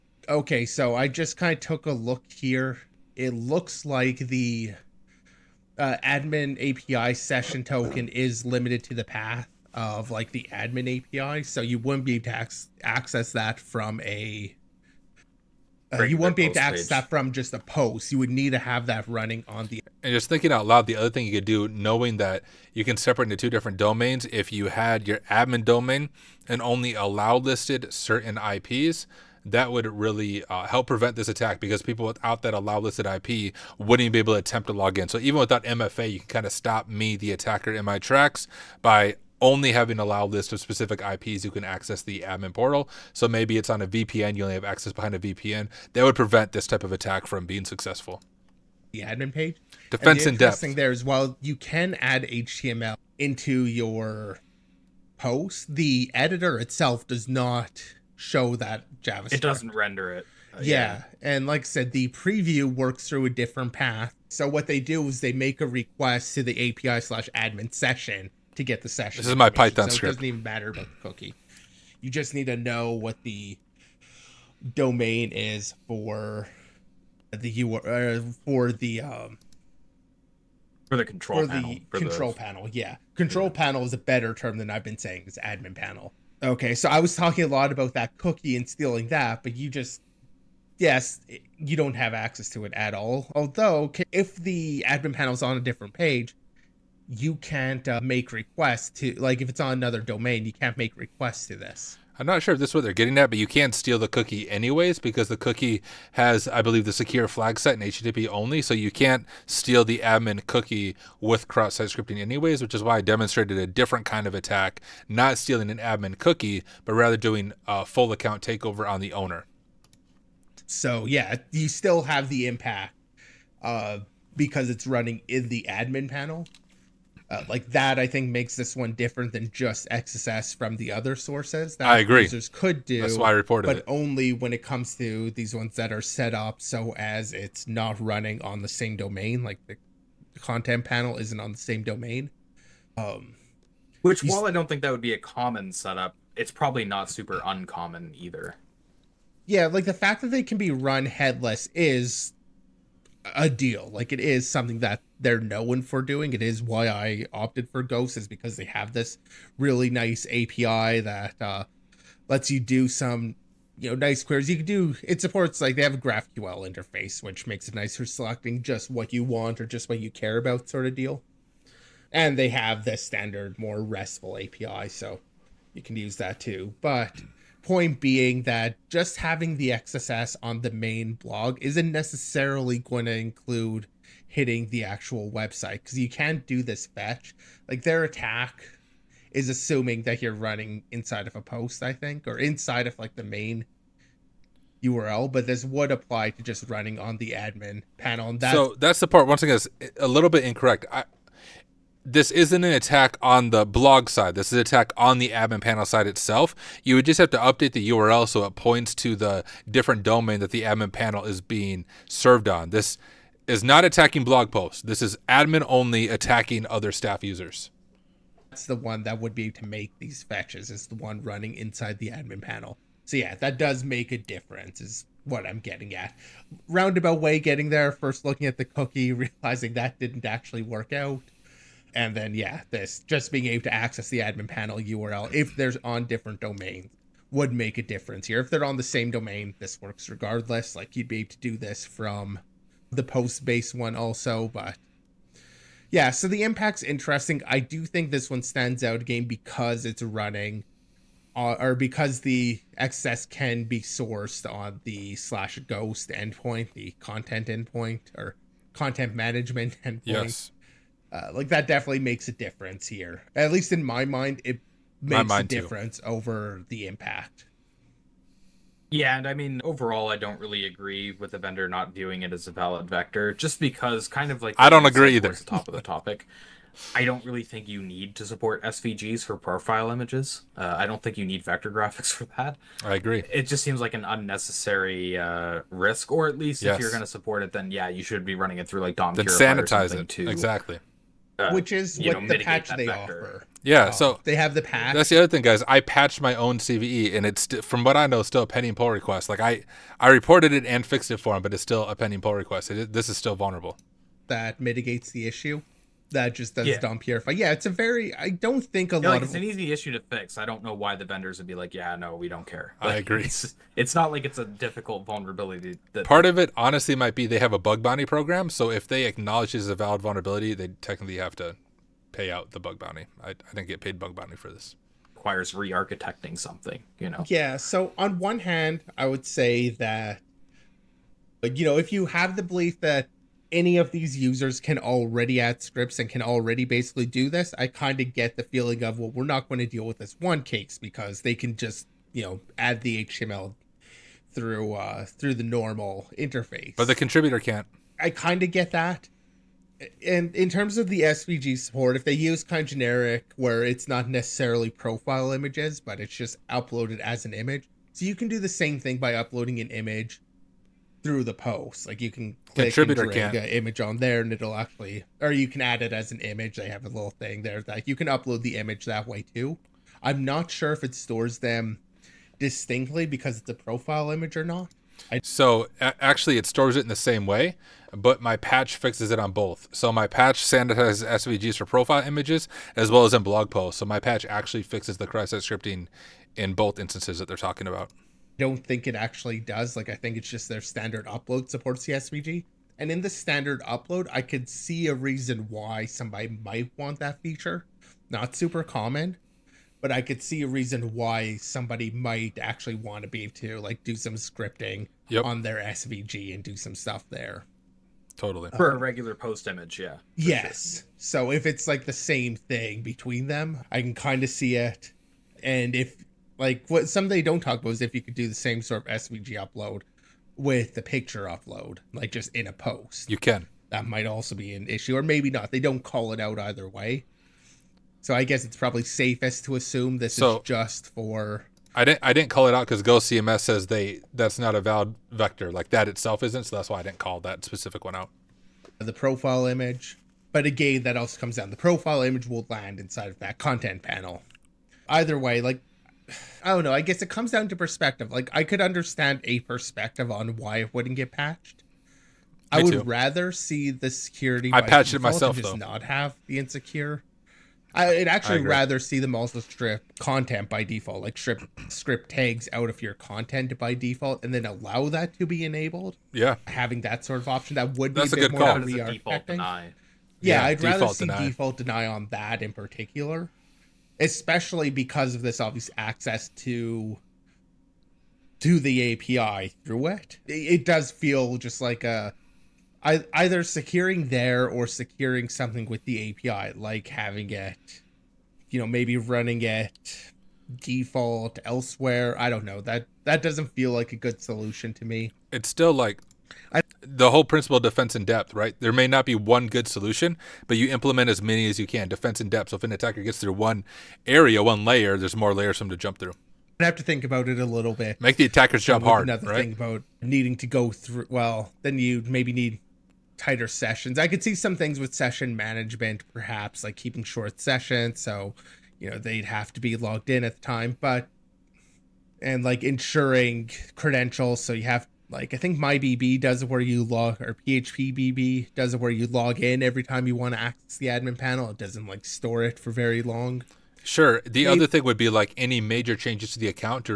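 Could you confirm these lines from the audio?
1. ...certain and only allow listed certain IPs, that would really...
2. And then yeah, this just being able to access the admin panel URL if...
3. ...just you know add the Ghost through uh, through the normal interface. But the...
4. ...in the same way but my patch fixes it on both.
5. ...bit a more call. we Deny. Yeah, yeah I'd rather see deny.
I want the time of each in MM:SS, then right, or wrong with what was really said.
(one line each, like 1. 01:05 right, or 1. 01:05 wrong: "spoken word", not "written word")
1. 00:25 wrong: "domain", not "certain"
2. 03:51 right
3. 05:41 wrong: "HTML", not "Ghost"
4. 06:16 right
5. 07:48 right.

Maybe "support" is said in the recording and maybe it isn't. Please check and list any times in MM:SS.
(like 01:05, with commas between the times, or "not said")
02:45, 04:38, 04:47, 05:51, 06:31.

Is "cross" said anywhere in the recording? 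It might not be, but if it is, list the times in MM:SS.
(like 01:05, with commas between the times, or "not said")
01:51, 06:25.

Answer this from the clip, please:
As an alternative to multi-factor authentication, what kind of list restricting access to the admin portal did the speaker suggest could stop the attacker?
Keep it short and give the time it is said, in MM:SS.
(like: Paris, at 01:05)
allowed list of specific IPs, at 00:40.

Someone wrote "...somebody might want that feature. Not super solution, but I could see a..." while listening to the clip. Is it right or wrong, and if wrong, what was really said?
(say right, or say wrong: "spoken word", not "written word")
wrong: "common", not "solution".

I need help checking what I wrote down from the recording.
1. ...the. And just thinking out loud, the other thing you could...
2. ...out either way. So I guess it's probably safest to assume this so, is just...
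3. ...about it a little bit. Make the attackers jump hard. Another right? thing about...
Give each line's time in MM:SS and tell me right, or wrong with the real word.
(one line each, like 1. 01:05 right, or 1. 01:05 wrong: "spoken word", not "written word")
1. 00:19 right
2. 07:06 right
3. 08:27 right.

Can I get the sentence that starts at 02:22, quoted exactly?
Um, Which, while I don't think that would be a common setup, it's probably not super uncommon either.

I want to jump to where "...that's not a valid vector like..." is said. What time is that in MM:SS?
07:14.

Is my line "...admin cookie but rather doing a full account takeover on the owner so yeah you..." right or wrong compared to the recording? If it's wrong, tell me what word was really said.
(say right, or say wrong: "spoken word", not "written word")
right.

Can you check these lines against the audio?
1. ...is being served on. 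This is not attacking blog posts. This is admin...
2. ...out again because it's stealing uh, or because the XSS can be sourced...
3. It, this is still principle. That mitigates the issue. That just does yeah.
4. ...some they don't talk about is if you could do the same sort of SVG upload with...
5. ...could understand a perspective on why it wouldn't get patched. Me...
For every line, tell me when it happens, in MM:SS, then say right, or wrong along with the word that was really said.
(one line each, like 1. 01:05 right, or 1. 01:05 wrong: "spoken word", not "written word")
1. 03:31 right
2. 04:08 wrong: "running", not "stealing"
3. 05:02 wrong: "vulnerable", not "principle"
4. 06:56 right
5. 07:28 right.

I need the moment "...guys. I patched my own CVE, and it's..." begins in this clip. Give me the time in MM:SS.
04:55.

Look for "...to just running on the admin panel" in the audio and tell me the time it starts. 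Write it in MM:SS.
03:16.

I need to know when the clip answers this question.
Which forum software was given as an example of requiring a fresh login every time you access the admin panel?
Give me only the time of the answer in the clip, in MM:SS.
08:47.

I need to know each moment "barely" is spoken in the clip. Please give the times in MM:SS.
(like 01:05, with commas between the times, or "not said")
not said.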